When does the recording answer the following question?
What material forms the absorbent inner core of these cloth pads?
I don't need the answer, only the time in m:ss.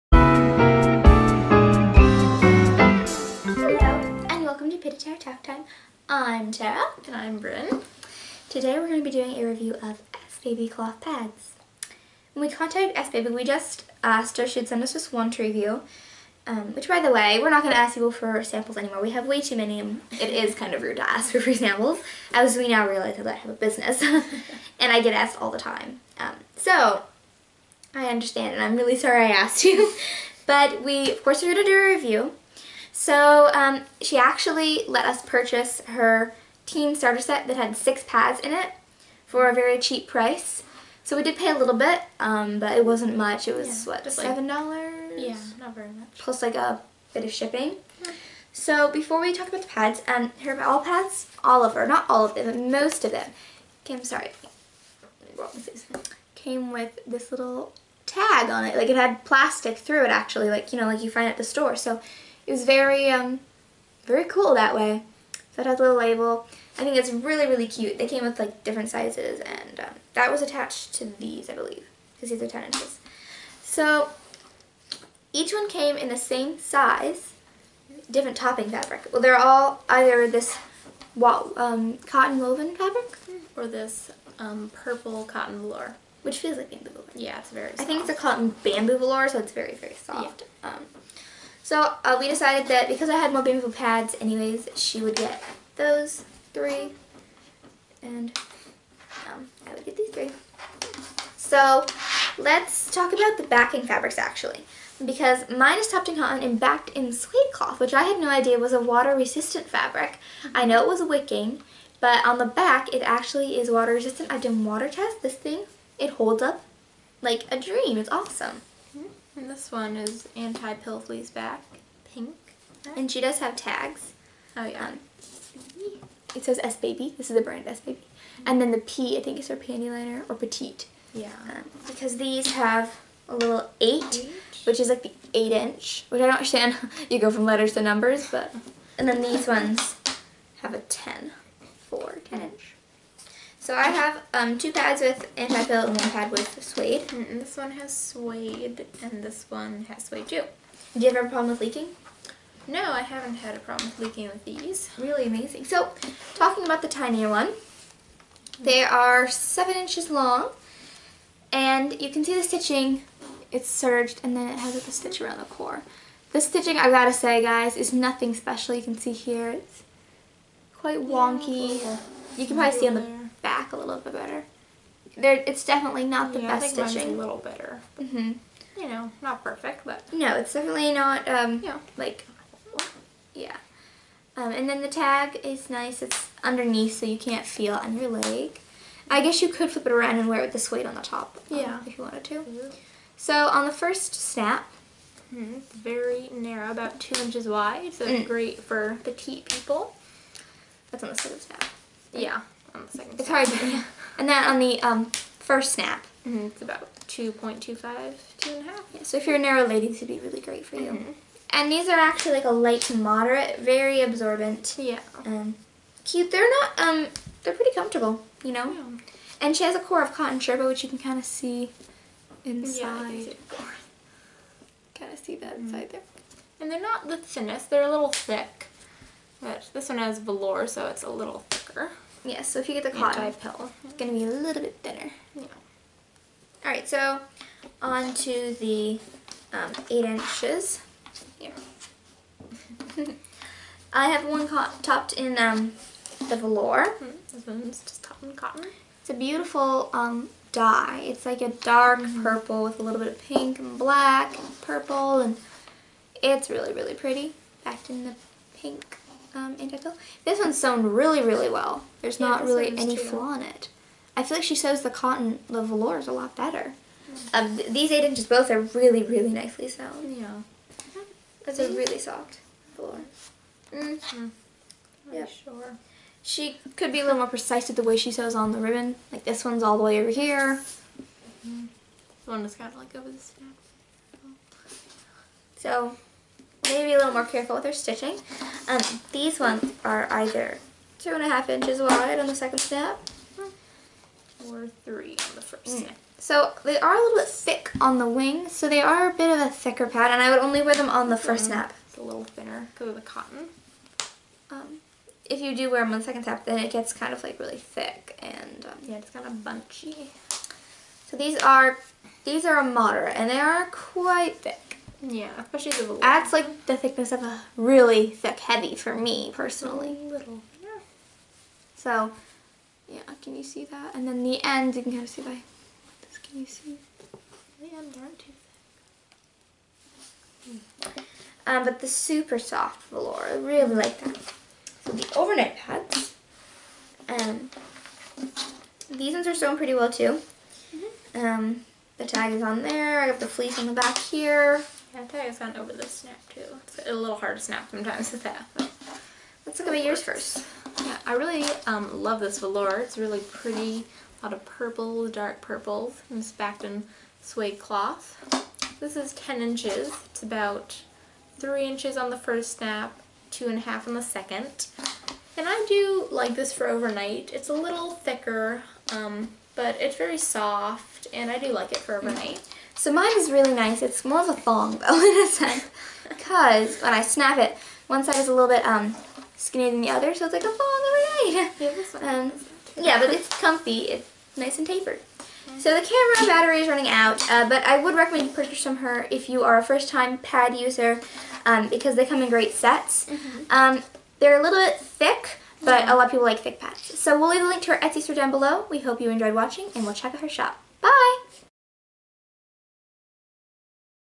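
3:40.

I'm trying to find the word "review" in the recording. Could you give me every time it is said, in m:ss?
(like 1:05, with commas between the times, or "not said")
0:09, 0:15, 0:31.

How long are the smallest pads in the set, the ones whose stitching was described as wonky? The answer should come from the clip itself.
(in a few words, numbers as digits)
7 inches.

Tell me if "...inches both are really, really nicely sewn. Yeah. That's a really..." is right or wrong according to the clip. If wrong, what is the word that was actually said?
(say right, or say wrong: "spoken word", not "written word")
right.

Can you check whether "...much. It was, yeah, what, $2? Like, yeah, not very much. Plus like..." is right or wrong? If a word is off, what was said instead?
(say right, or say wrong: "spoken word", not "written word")
wrong: "7", not "2".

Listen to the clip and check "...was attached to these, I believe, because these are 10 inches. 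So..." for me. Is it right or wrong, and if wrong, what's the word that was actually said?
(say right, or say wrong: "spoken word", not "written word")
right.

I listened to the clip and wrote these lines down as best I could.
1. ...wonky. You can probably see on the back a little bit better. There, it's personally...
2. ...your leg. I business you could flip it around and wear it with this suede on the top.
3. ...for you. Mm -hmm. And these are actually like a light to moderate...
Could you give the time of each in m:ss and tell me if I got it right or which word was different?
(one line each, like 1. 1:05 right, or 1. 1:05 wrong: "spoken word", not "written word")
1. 2:50 wrong: "definitely", not "personally"
2. 3:07 wrong: "guess", not "business"
3. 3:30 right.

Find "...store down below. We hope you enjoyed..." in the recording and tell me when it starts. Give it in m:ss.
6:38.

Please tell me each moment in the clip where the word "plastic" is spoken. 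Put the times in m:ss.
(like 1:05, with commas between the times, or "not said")
0:59.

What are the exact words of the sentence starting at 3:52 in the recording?
Yes, so if you get the cotton pill, it's going to be a little bit thinner.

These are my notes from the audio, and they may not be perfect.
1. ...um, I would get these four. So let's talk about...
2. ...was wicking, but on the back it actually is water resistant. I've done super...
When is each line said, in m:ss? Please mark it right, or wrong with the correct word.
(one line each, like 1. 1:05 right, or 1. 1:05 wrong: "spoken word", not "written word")
1. 1:39 wrong: "three", not "four"
2. 1:50 wrong: "water", not "super".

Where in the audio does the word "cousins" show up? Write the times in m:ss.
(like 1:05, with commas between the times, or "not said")
not said.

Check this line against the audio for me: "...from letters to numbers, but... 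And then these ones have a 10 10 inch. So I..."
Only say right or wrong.
right.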